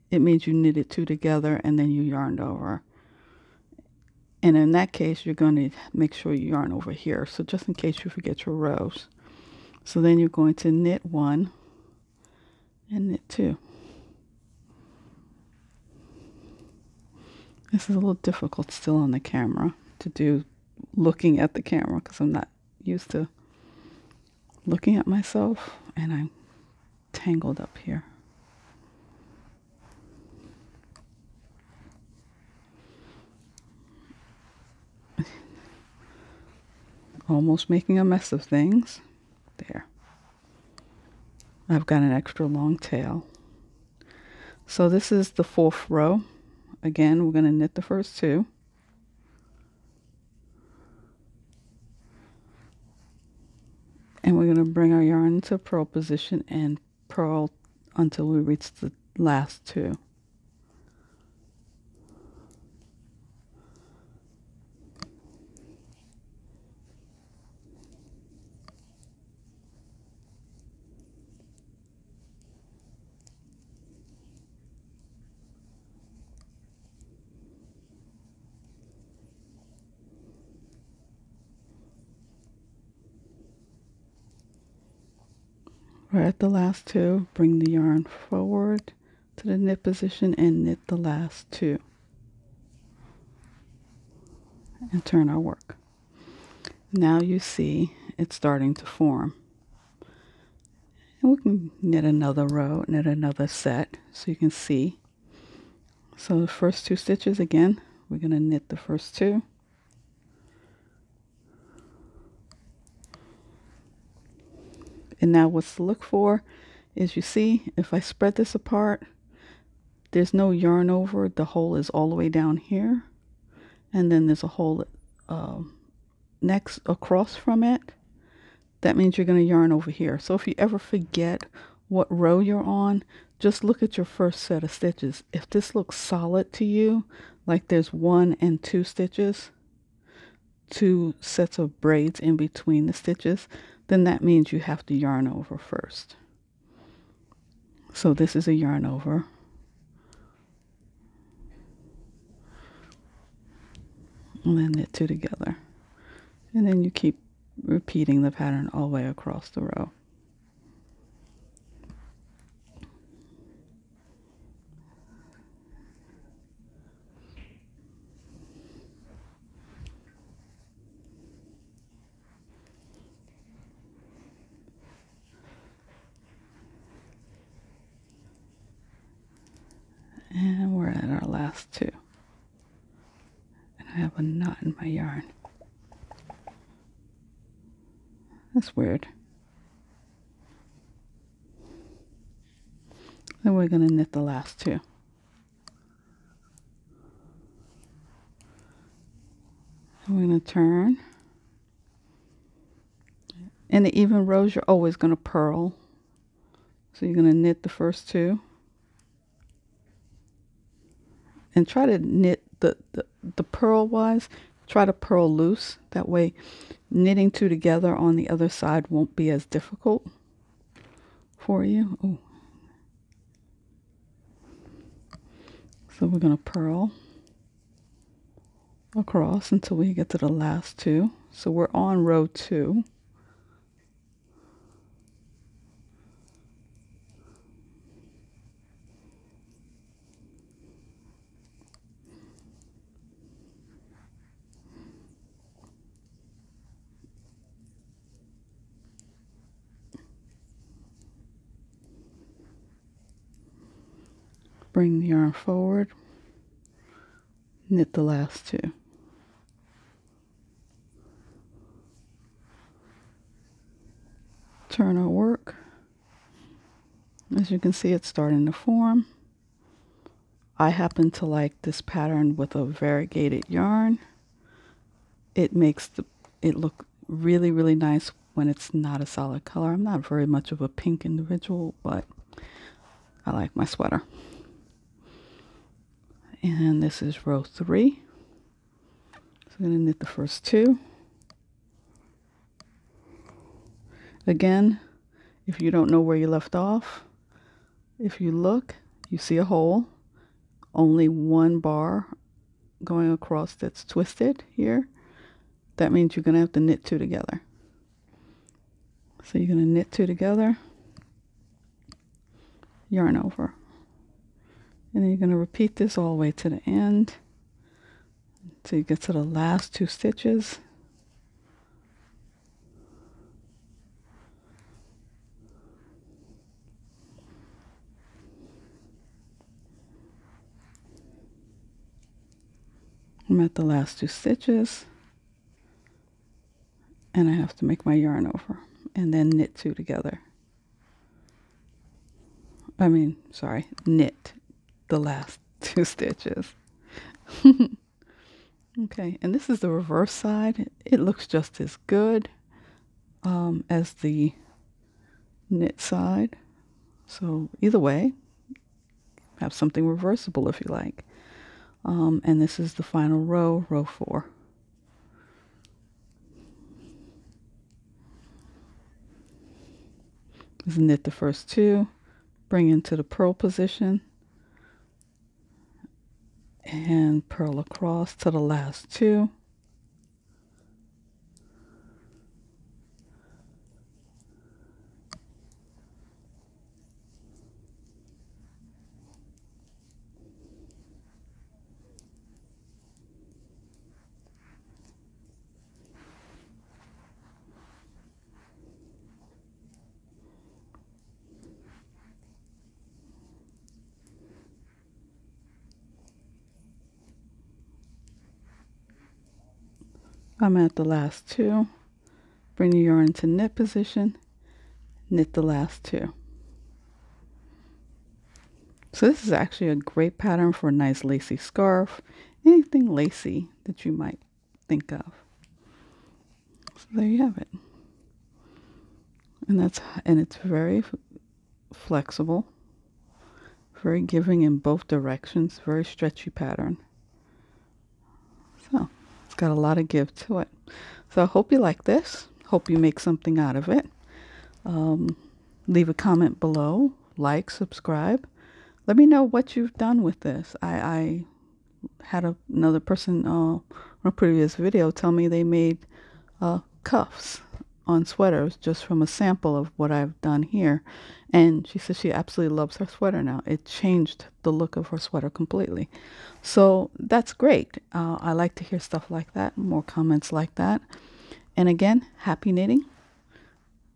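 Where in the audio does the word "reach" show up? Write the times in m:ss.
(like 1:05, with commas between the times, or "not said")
0:58.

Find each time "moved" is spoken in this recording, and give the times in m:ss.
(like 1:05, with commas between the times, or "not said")
not said.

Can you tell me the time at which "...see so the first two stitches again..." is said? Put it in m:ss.
1:44.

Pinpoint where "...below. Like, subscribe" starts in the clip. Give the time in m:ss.
7:26.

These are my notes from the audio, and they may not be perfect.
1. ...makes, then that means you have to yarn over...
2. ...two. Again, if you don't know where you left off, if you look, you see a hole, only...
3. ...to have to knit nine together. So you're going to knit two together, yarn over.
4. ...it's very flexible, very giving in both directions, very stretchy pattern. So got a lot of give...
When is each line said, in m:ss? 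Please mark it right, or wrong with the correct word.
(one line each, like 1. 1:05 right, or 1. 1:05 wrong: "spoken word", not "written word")
1. 2:22 wrong: "stitches", not "makes"
2. 4:50 right
3. 5:06 wrong: "two", not "nine"
4. 7:10 right.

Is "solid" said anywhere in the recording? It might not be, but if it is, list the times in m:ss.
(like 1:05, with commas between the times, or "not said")
2:15, 4:39.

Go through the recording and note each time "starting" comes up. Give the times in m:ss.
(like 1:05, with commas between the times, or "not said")
1:38, 4:28.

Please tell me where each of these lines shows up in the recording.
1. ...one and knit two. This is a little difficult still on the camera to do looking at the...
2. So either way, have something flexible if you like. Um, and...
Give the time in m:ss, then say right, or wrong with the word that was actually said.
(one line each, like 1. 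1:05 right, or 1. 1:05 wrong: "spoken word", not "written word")
1. 0:11 right
2. 5:57 wrong: "reversible", not "flexible".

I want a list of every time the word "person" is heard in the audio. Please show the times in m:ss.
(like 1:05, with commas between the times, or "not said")
7:32.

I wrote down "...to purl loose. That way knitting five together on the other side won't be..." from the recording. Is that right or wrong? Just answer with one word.
wrong.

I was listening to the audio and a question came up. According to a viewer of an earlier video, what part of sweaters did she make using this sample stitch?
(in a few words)
Cuffs.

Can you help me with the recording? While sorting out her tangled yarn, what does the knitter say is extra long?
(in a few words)
Tail.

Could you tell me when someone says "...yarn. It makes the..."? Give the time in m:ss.
4:33.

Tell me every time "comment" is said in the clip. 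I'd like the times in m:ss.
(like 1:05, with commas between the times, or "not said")
7:25, 7:49.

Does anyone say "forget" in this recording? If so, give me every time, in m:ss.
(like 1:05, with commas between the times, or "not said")
0:08, 2:10.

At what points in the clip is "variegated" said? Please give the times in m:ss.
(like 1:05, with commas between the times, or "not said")
4:32.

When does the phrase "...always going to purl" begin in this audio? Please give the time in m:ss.
3:24.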